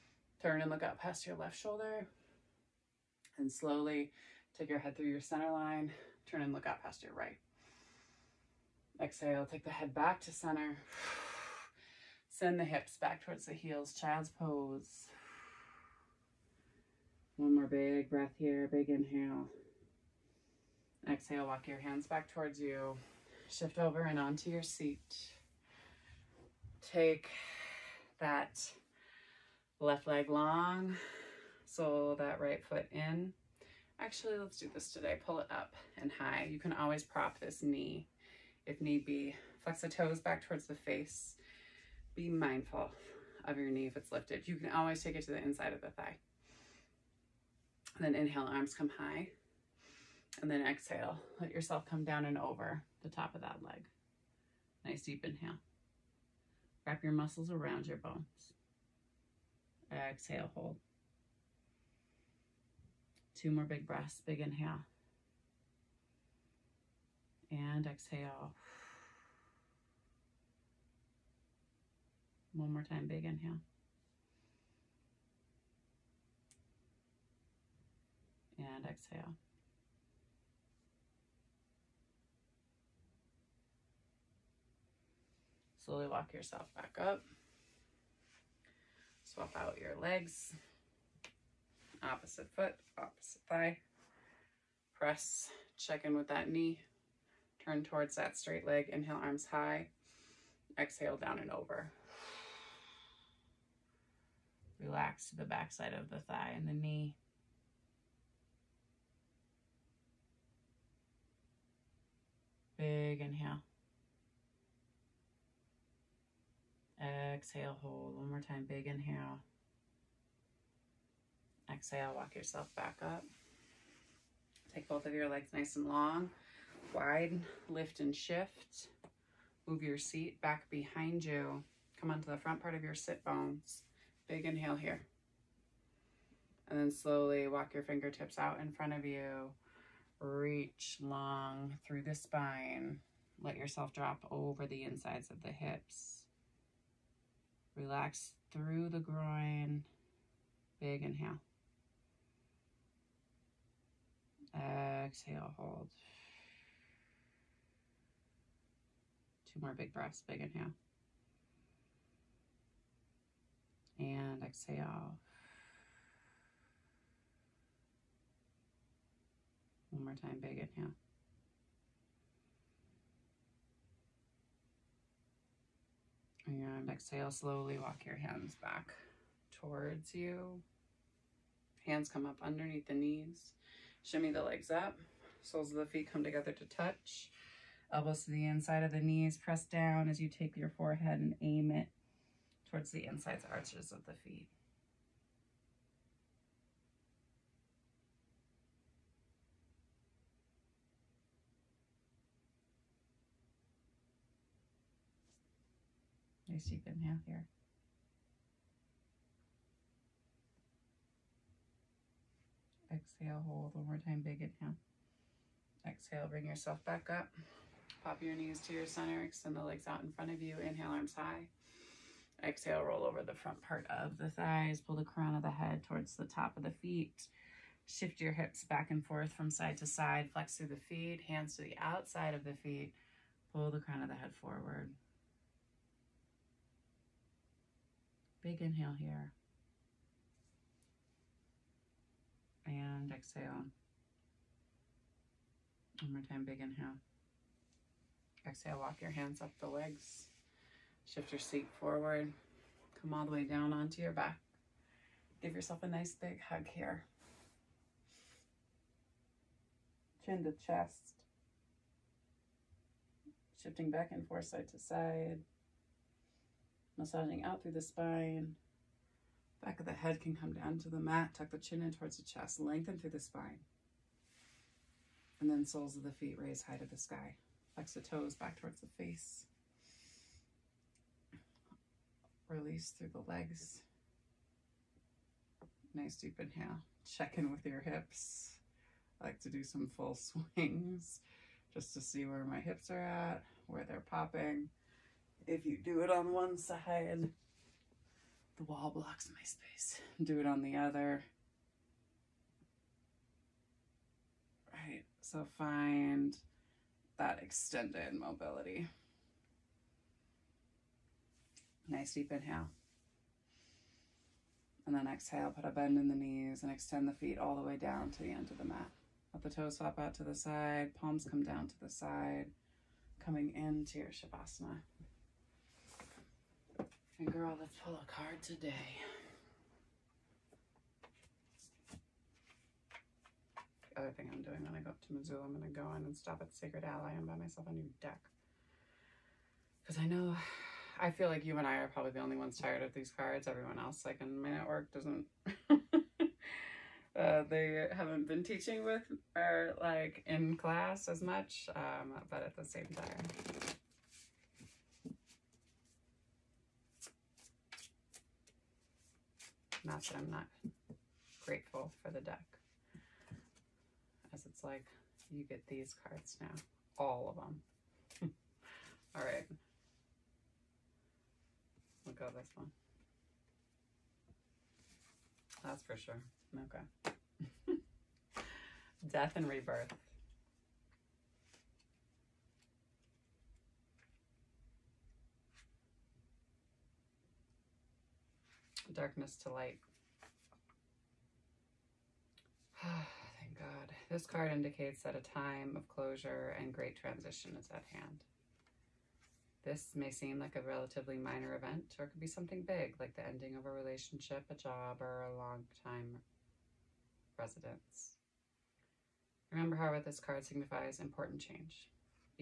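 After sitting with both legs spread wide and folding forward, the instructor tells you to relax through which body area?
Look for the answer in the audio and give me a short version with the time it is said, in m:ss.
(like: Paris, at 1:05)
Groin, at 2:27.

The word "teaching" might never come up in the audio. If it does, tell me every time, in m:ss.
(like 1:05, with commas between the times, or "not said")
5:48.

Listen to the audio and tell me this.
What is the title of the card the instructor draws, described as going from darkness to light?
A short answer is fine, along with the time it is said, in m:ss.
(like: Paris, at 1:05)
Death and rebirth, at 6:19.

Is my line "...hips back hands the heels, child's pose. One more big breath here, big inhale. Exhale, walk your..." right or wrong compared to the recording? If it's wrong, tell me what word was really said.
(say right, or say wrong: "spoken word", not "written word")
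wrong: "towards", not "hands".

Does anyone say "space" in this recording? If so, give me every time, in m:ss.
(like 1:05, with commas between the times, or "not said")
3:26, 4:59.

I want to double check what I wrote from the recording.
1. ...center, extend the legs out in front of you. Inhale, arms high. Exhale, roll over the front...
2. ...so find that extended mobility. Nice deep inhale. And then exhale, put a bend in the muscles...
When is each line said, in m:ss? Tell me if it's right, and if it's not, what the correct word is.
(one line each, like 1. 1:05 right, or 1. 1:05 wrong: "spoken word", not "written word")
1. 3:38 right
2. 5:05 wrong: "knees", not "muscles".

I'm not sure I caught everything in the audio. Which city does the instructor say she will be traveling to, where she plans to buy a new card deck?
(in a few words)
Missoula.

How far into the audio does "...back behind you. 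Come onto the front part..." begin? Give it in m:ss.
2:10.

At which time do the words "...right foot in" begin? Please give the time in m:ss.
0:32.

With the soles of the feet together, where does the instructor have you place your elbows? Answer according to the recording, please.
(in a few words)
Inside of the knees.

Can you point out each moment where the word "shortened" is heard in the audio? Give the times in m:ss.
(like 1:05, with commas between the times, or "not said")
not said.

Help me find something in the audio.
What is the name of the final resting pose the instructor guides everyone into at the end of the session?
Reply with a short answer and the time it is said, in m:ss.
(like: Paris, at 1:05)
Shavasana, at 5:24.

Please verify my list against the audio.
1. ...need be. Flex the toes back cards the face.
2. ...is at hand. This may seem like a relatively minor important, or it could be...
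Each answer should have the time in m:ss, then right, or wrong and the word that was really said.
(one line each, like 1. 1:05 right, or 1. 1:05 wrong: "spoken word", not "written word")
1. 0:38 wrong: "towards", not "cards"
2. 6:37 wrong: "event", not "important".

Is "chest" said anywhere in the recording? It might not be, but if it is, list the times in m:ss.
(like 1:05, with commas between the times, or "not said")
4:20, 4:32.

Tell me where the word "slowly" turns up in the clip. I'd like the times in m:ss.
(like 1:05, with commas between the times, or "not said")
0:03, 1:25, 2:16, 2:57.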